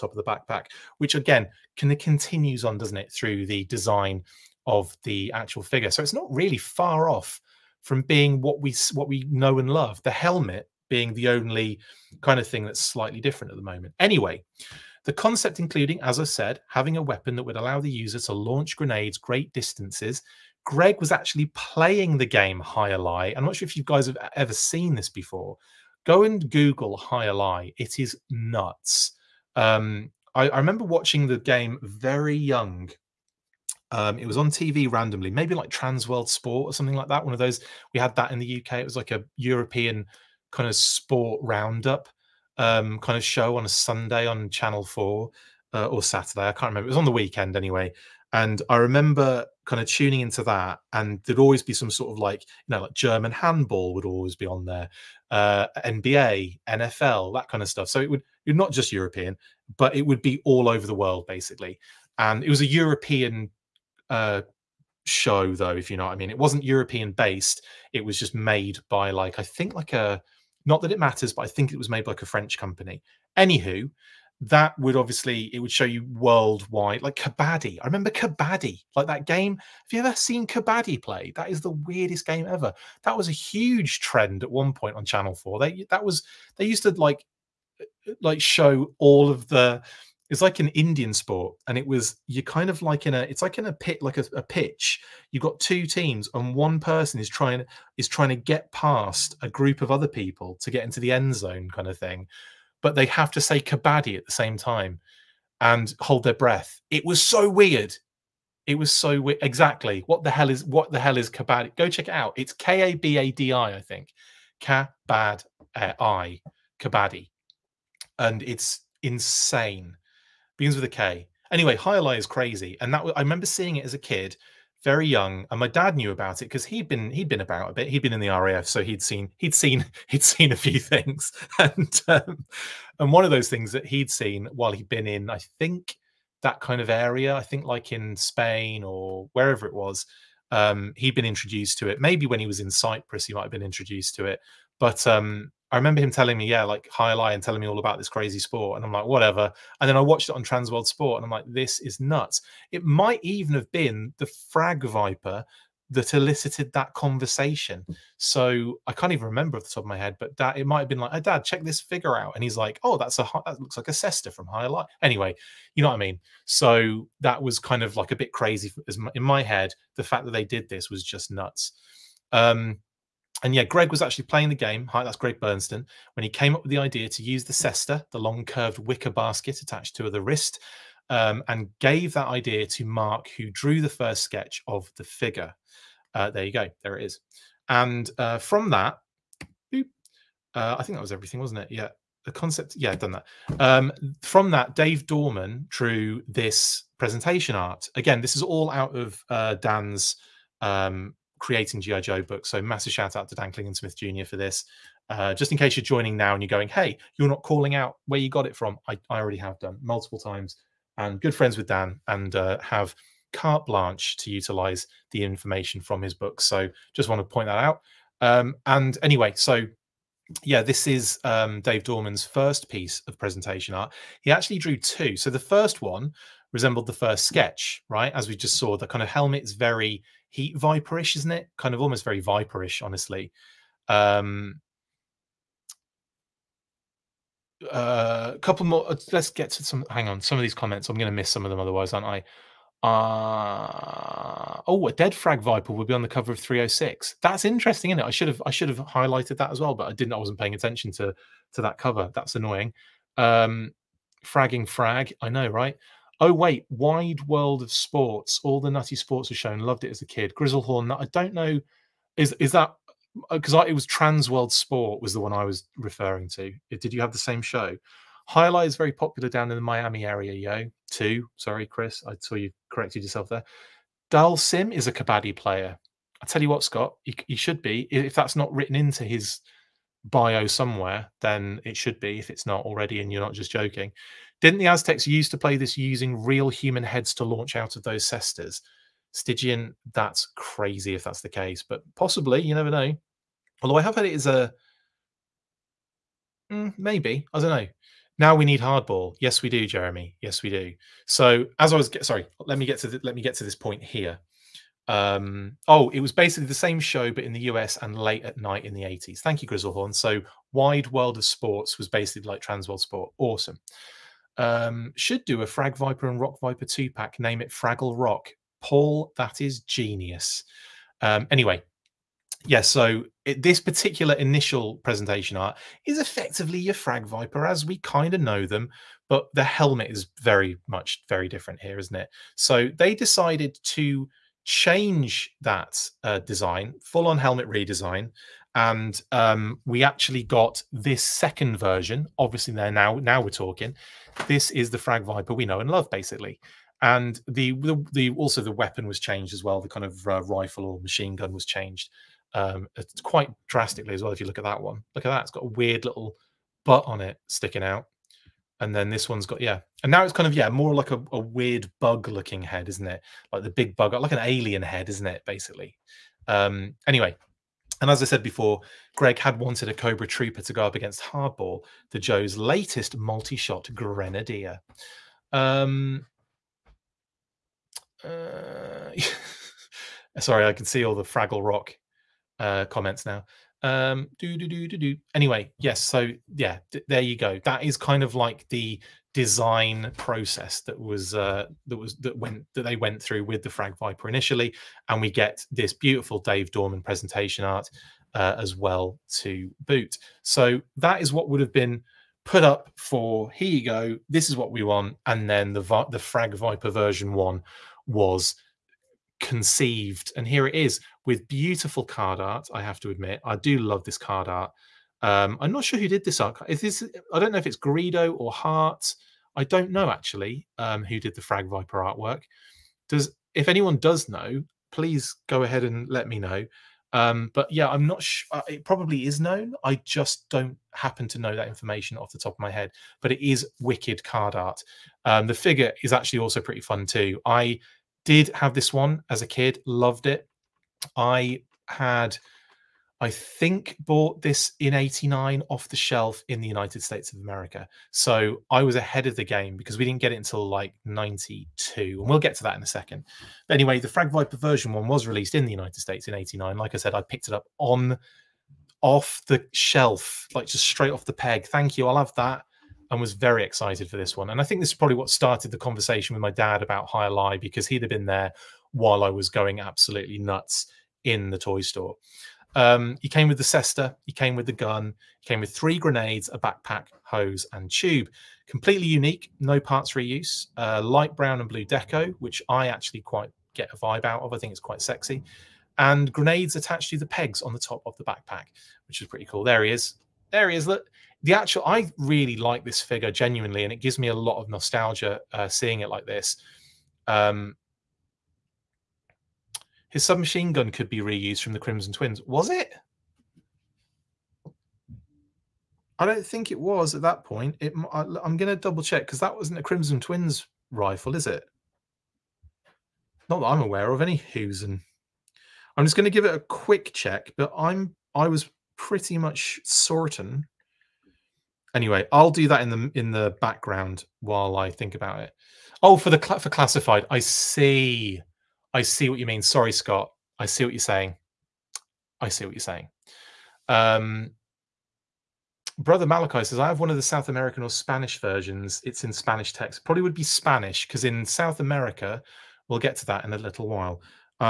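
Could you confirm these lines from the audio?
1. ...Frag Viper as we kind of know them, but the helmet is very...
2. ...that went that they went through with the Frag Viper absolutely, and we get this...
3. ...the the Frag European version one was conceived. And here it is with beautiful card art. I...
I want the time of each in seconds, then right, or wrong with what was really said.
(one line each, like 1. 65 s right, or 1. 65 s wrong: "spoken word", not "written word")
1. 326 s right
2. 391 s wrong: "initially", not "absolutely"
3. 405 s wrong: "Viper", not "European".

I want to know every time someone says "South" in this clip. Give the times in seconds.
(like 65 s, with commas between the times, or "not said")
537 s, 541 s.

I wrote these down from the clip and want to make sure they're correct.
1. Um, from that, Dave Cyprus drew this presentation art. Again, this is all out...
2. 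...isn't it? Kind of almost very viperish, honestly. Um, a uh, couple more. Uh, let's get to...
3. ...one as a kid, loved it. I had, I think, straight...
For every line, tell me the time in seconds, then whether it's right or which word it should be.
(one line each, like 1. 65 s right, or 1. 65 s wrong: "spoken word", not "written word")
1. 193 s wrong: "Dorman", not "Cyprus"
2. 231 s right
3. 438 s wrong: "bought", not "straight".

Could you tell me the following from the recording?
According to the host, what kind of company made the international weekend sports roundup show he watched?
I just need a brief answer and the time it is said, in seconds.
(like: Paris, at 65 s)
a French company, at 72 s.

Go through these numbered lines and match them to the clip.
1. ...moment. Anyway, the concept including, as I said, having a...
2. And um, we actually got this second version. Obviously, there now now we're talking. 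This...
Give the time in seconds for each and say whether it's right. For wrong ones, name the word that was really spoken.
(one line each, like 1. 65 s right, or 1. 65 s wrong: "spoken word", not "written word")
1. 13 s right
2. 338 s right.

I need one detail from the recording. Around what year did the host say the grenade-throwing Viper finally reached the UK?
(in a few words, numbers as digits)
1992.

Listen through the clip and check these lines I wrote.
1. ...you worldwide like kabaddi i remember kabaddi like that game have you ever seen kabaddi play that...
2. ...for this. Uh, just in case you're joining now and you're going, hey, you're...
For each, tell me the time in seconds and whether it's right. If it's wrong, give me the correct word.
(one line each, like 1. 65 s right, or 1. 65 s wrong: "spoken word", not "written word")
1. 75 s right
2. 204 s right.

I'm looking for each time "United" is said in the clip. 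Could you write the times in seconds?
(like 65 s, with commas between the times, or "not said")
446 s, 455 s.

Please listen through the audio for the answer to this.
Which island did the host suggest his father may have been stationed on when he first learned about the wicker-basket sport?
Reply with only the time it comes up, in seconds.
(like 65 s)
142 s.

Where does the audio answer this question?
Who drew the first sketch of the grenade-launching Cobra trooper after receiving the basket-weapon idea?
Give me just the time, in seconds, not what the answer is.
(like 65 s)
182 s.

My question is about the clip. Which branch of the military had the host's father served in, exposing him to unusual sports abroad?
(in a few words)
the RAF.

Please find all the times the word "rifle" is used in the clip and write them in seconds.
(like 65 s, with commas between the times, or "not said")
350 s, 510 s.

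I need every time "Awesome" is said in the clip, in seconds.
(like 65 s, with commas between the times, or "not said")
313 s.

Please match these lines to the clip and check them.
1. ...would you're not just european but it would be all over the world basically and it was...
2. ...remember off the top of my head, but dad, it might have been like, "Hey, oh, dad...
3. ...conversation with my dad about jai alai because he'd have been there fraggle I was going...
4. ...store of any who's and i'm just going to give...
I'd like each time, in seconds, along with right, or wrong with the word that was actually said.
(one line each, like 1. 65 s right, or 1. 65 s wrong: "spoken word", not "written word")
1. 58 s right
2. 159 s right
3. 465 s wrong: "while", not "fraggle"
4. 513 s wrong: "aware", not "store".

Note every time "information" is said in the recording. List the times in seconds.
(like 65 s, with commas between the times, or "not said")
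215 s, 431 s.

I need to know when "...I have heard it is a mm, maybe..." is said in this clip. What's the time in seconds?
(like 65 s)
293 s.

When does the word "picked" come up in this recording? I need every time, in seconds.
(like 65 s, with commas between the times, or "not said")
457 s.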